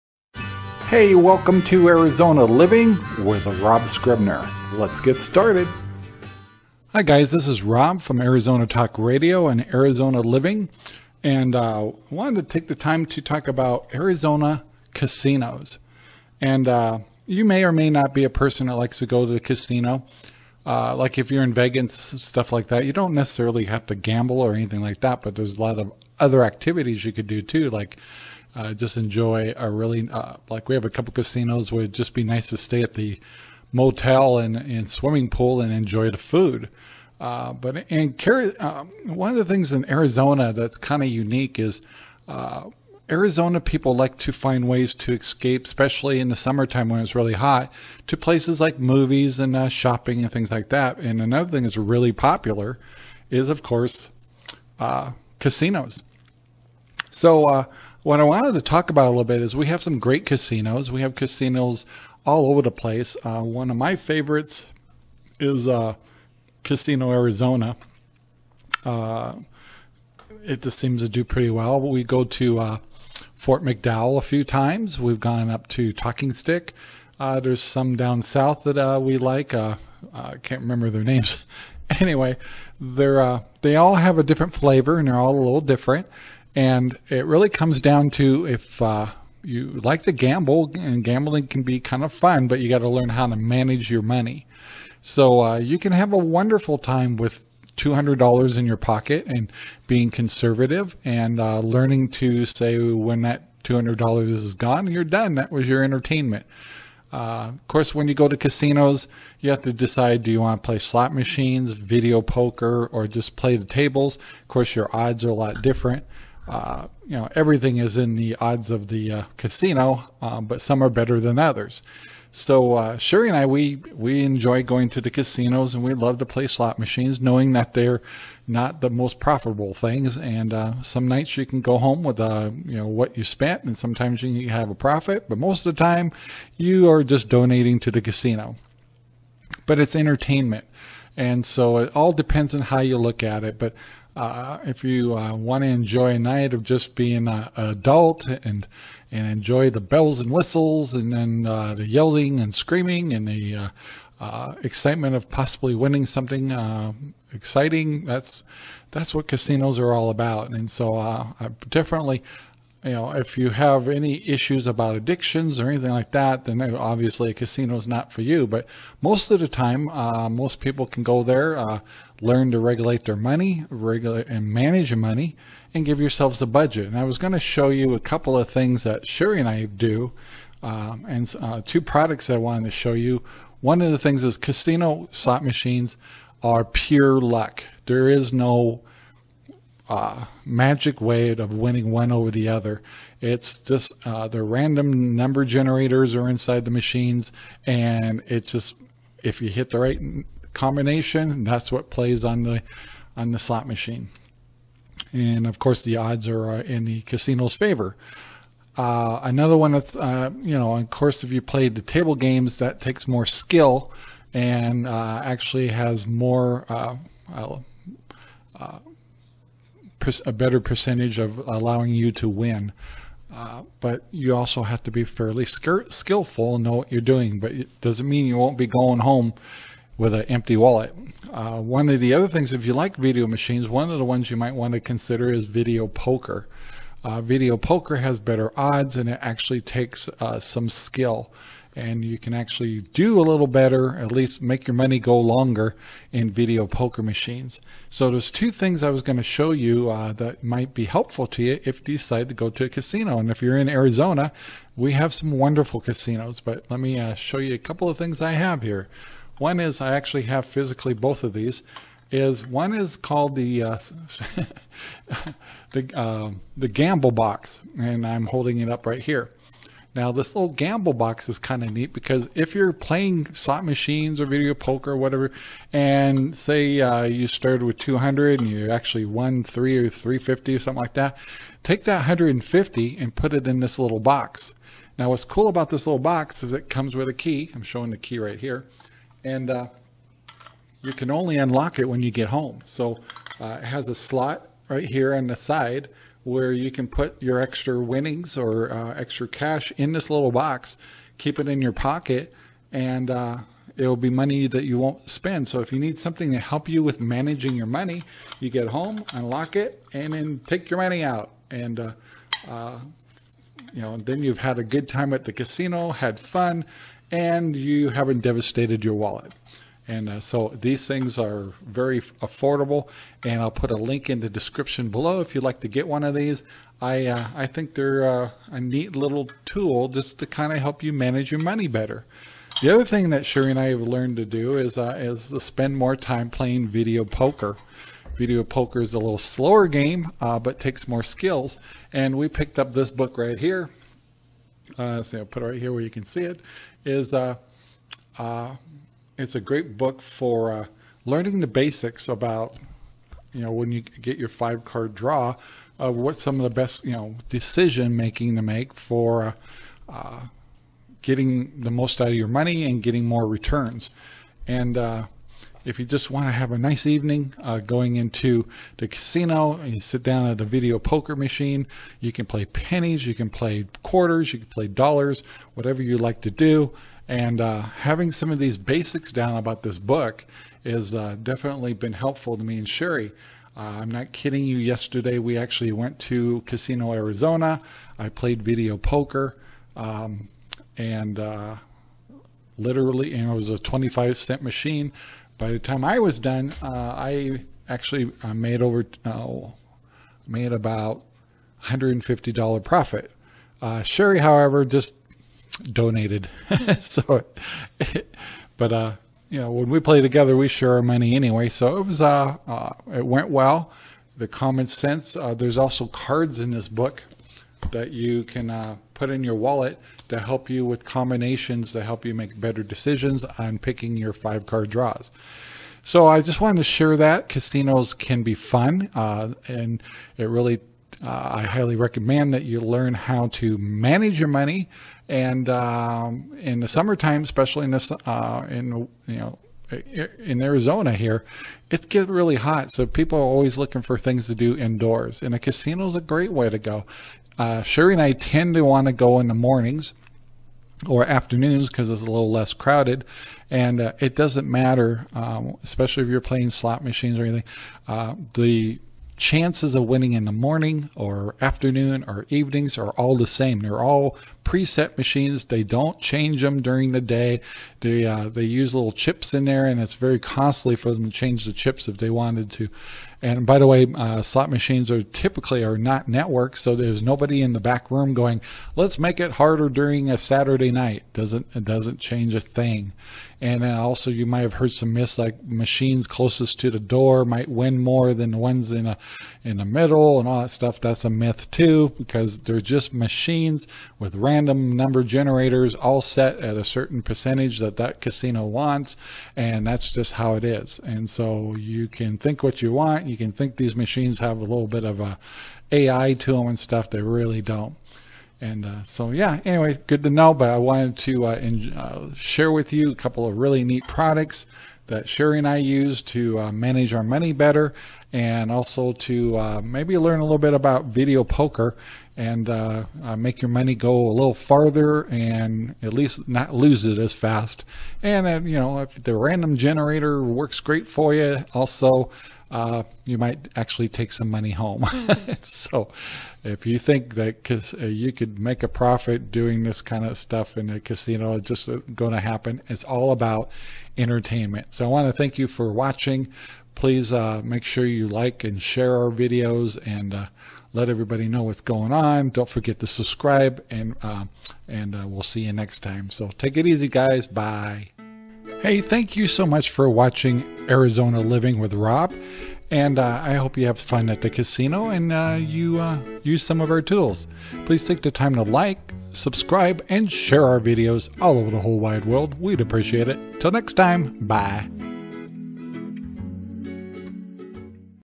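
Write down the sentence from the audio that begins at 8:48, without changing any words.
And, you know, if the random generator works great for you, also uh, you might actually take some money home.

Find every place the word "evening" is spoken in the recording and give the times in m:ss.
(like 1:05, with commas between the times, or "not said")
6:06, 7:42.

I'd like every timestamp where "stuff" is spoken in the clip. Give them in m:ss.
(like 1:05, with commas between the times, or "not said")
0:22, 8:10, 8:26, 9:00.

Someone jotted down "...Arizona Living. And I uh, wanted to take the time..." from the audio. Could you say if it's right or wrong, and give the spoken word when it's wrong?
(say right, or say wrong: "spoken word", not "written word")
right.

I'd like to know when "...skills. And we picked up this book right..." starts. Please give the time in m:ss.
5:41.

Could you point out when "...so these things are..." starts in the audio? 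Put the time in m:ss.
5:20.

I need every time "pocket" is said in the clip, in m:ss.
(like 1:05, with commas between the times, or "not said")
1:38, 5:01.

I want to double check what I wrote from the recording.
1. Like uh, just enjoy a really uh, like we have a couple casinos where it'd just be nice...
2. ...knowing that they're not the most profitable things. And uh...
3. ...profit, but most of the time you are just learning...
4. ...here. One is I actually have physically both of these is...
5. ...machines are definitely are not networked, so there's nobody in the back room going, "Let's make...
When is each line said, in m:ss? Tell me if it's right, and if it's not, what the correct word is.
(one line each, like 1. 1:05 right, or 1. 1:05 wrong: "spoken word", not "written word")
1. 0:27 right
2. 2:07 right
3. 2:14 wrong: "donating", not "learning"
4. 4:18 right
5. 7:54 wrong: "typically", not "definitely".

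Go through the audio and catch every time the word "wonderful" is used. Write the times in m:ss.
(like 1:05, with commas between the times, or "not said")
1:36, 4:15.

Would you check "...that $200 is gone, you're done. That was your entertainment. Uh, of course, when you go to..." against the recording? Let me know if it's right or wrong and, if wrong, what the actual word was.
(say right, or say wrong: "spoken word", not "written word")
right.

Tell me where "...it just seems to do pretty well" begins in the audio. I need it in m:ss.
1:10.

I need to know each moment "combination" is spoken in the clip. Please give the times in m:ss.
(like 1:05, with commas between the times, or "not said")
3:20, 7:00.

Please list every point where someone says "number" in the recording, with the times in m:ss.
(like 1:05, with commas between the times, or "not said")
3:15, 8:14.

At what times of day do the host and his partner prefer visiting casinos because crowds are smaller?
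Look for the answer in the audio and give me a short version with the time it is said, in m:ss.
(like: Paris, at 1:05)
mornings or afternoons, at 7:29.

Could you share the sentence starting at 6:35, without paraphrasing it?
By the time I was done, uh, I actually uh, made over made about $150 profit.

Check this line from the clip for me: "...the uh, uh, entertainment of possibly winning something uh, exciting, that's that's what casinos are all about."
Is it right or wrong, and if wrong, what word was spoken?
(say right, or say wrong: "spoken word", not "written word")
wrong: "excitement", not "entertainment".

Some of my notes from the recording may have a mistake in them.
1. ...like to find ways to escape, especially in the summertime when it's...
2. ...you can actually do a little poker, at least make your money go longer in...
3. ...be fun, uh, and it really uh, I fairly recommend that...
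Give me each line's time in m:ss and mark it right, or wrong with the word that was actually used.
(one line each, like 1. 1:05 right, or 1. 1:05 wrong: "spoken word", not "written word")
1. 0:43 right
2. 4:02 wrong: "better", not "poker"
3. 7:08 wrong: "highly", not "fairly".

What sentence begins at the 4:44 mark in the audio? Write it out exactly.
Now, what's cool about this little box is it comes with a key.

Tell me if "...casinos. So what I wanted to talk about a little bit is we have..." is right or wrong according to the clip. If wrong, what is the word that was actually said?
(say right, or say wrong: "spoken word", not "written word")
right.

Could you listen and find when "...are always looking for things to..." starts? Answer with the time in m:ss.
7:23.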